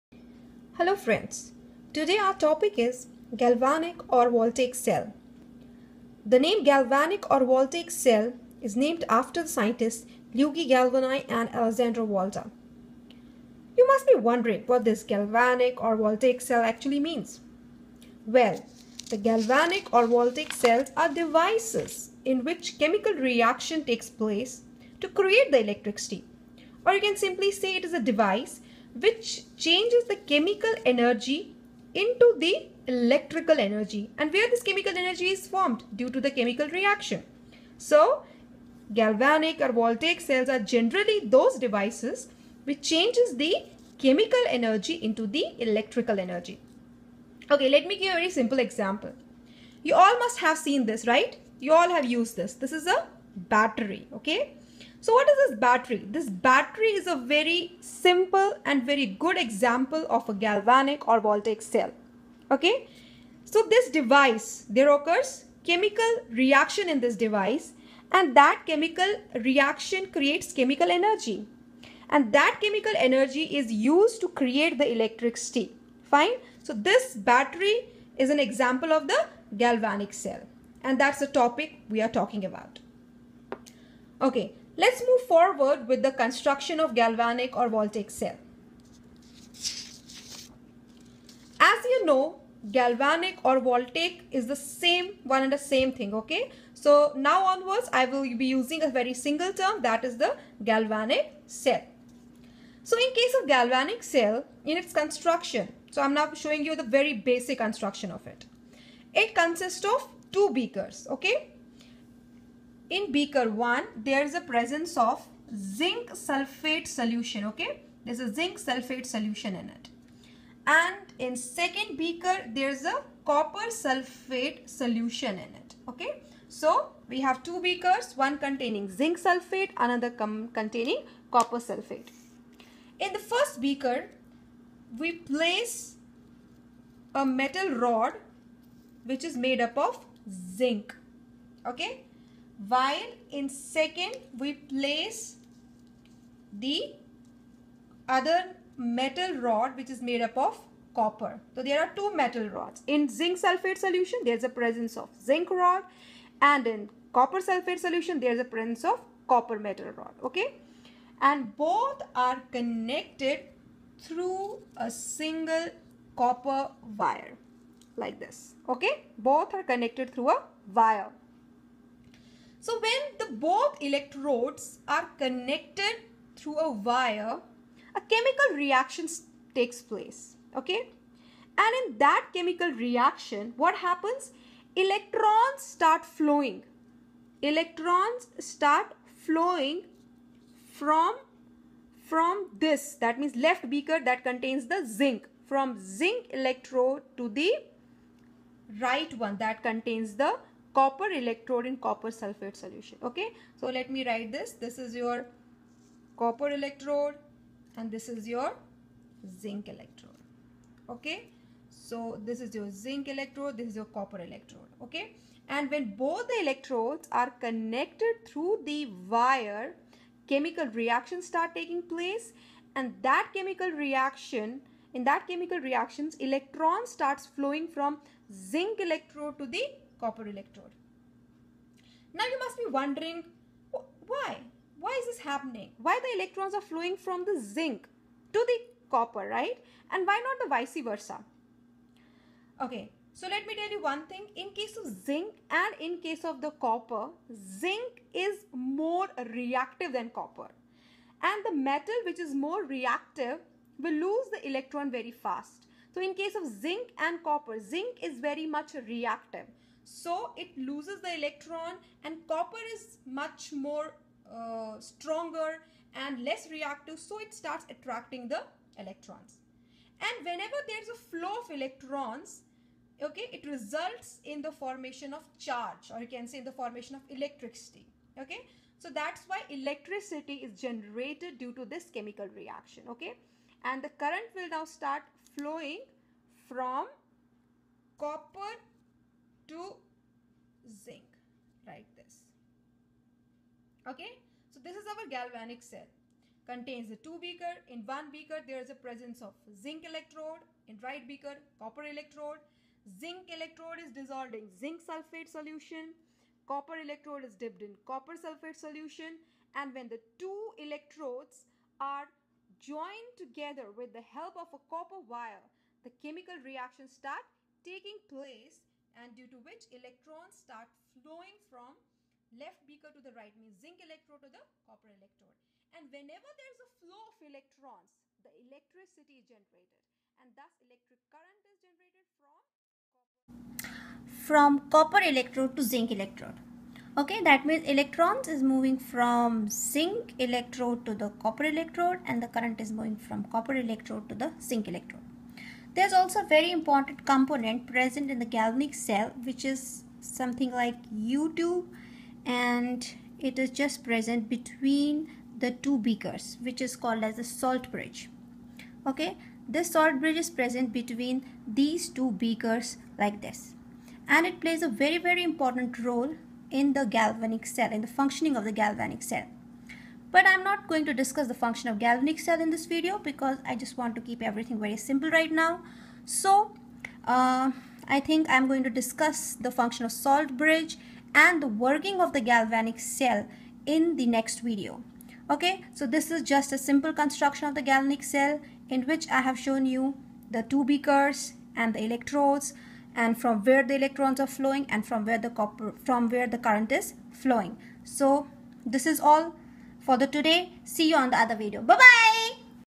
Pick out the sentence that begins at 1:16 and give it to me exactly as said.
So this battery is an example of the galvanic cell.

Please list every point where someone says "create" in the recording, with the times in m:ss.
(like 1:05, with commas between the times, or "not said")
0:25, 1:10, 1:14.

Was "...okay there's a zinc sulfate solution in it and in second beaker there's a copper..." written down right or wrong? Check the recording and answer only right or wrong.
right.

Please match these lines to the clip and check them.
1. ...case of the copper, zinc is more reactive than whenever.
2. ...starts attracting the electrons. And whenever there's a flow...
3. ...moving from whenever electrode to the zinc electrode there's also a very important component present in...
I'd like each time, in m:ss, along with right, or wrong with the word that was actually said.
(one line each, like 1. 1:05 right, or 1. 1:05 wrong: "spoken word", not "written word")
1. 4:06 wrong: "copper", not "whenever"
2. 4:27 right
3. 5:42 wrong: "copper", not "whenever".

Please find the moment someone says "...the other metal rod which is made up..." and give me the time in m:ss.
2:26.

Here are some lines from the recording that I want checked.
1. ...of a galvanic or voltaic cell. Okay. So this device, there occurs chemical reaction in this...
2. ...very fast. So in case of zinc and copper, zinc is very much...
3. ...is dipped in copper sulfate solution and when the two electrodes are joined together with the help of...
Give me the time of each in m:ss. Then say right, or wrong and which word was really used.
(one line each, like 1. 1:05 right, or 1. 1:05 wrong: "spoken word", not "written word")
1. 1:00 right
2. 4:14 right
3. 5:07 right.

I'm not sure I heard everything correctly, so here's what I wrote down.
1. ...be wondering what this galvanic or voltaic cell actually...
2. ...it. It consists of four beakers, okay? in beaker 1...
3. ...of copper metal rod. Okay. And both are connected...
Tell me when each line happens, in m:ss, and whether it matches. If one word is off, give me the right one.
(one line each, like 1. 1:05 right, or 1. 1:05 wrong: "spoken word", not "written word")
1. 0:14 right
2. 1:48 wrong: "two", not "four"
3. 2:38 right.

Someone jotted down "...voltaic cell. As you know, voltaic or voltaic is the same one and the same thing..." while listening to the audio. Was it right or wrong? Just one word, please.
wrong.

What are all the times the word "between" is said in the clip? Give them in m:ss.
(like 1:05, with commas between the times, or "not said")
5:54, 6:00.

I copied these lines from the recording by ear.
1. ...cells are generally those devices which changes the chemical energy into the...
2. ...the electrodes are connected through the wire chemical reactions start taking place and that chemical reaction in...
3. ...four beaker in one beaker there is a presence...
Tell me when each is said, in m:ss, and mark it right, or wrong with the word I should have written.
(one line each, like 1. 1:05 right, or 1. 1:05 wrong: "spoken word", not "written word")
1. 0:40 right
2. 3:36 right
3. 4:57 wrong: "two", not "four".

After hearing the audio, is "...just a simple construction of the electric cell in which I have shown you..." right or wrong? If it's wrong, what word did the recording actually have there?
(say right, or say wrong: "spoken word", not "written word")
wrong: "galvanic", not "electric".